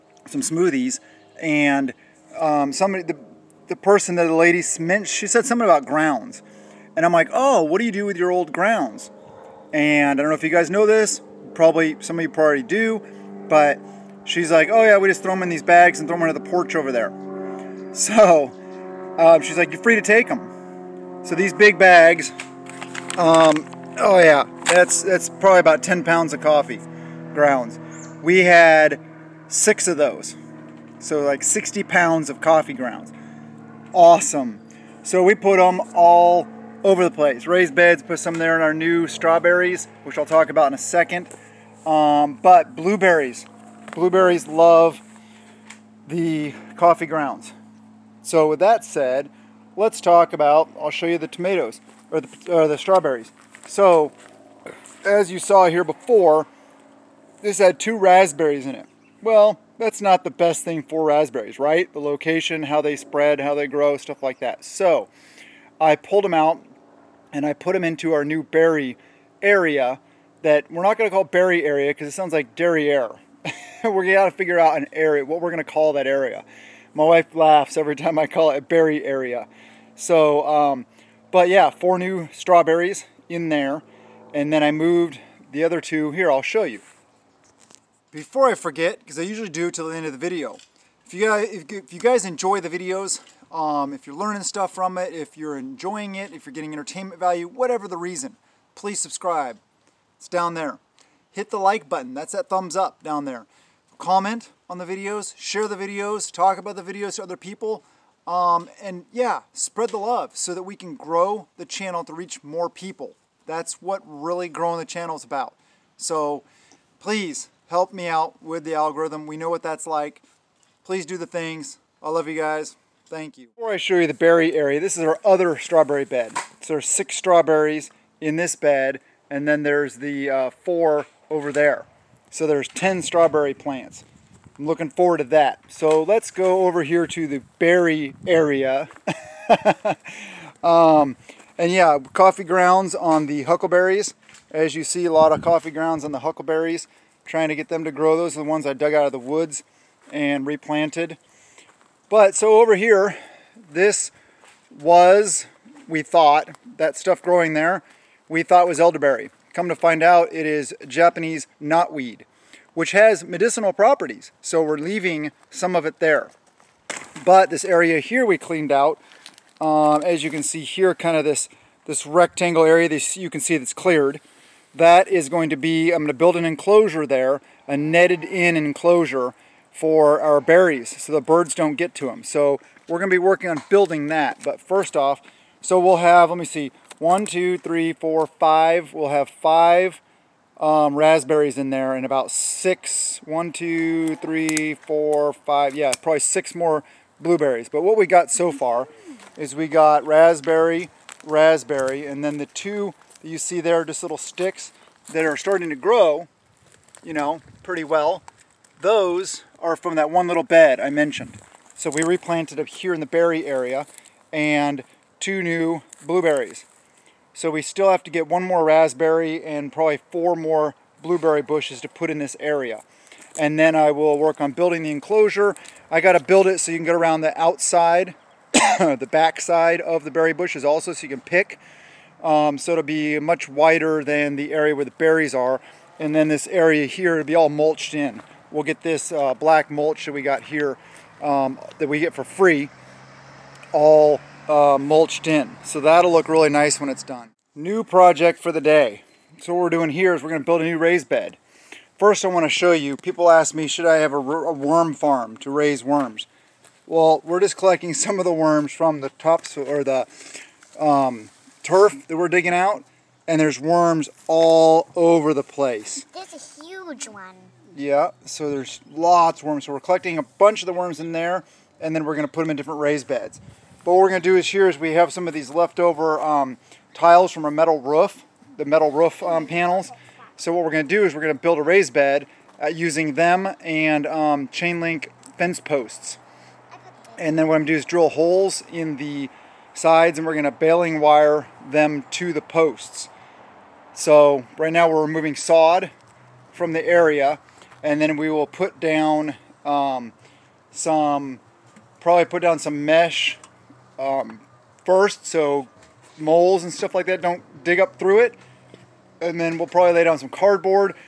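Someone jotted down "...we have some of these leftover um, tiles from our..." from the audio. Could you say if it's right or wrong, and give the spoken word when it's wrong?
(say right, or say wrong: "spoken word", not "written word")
right.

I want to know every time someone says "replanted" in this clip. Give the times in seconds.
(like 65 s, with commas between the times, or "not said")
150 s, 212 s.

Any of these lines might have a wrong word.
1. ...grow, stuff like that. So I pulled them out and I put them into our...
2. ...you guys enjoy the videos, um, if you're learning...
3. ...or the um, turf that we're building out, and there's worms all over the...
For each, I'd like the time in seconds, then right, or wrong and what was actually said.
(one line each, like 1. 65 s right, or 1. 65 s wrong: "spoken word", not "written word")
1. 63 s right
2. 91 s right
3. 259 s wrong: "digging", not "building".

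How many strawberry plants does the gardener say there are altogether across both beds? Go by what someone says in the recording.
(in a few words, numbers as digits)
10.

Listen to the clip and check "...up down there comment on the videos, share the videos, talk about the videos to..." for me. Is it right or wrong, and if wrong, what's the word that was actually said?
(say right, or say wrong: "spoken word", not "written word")
right.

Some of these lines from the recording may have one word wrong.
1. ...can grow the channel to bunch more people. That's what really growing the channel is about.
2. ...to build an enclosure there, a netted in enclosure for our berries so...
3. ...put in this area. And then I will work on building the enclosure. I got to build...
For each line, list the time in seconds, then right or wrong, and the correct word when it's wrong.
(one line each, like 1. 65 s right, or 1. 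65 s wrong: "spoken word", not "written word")
1. 110 s wrong: "reach", not "bunch"
2. 176 s right
3. 221 s right.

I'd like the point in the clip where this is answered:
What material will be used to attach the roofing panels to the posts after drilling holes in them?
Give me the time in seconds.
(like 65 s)
290 s.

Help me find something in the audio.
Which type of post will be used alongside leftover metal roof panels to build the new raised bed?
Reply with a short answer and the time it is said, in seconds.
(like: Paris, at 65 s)
Chain link fence posts, at 284 s.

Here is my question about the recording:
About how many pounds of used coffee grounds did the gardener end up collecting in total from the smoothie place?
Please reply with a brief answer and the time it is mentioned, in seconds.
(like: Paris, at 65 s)
60 pounds, at 31 s.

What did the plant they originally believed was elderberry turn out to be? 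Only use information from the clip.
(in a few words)
Japanese knotweed.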